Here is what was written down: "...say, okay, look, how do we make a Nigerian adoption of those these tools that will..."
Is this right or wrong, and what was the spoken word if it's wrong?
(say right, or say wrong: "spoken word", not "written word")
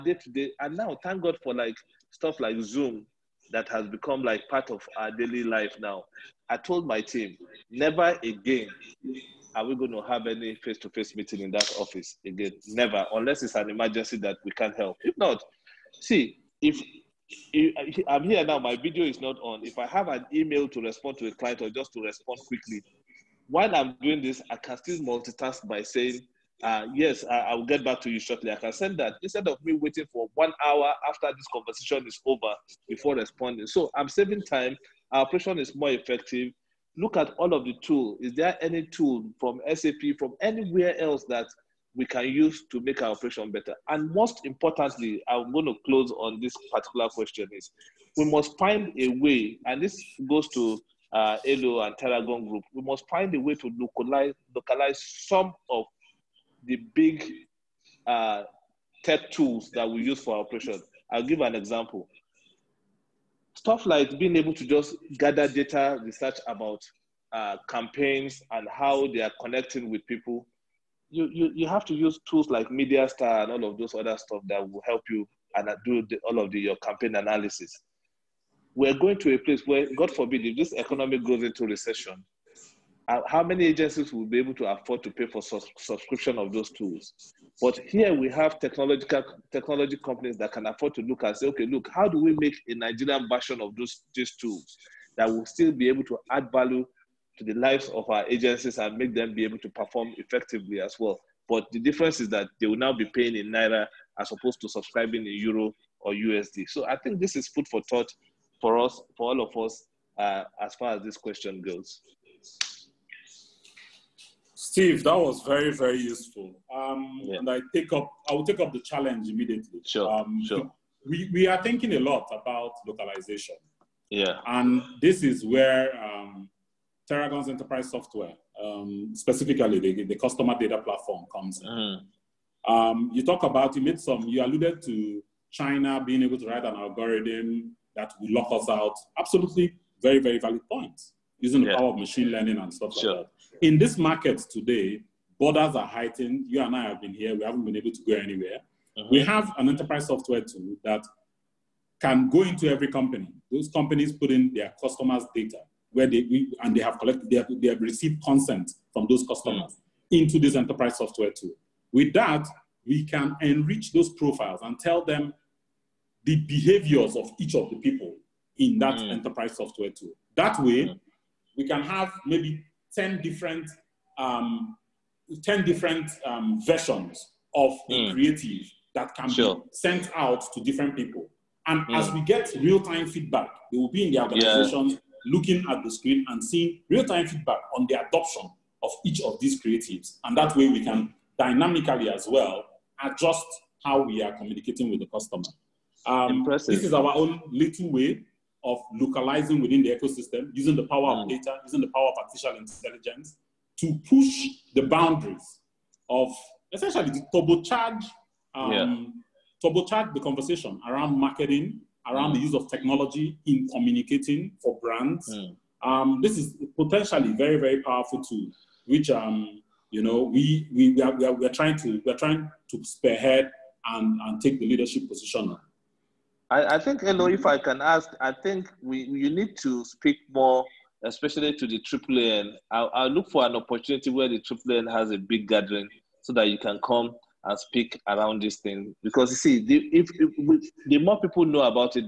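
wrong: "version", not "adoption".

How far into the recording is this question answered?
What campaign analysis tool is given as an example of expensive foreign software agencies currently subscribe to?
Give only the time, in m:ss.
1:12.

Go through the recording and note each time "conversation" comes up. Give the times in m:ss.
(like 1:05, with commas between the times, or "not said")
0:31, 3:30.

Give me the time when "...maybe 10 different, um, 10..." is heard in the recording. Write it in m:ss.
2:52.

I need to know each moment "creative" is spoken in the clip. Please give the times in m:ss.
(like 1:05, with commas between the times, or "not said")
2:58, 3:09.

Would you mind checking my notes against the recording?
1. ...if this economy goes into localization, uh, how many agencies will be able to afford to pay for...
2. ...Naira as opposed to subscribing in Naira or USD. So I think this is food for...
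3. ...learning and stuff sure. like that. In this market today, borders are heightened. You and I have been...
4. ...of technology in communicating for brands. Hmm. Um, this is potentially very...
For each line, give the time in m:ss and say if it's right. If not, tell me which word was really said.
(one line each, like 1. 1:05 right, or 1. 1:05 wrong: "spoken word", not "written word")
1. 1:20 wrong: "recession", not "localization"
2. 1:43 wrong: "Euro", not "Naira"
3. 2:22 right
4. 3:32 right.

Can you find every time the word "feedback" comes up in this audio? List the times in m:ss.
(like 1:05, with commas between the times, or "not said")
3:03, 3:07.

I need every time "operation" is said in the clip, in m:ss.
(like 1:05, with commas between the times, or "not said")
0:35, 0:43, 1:00.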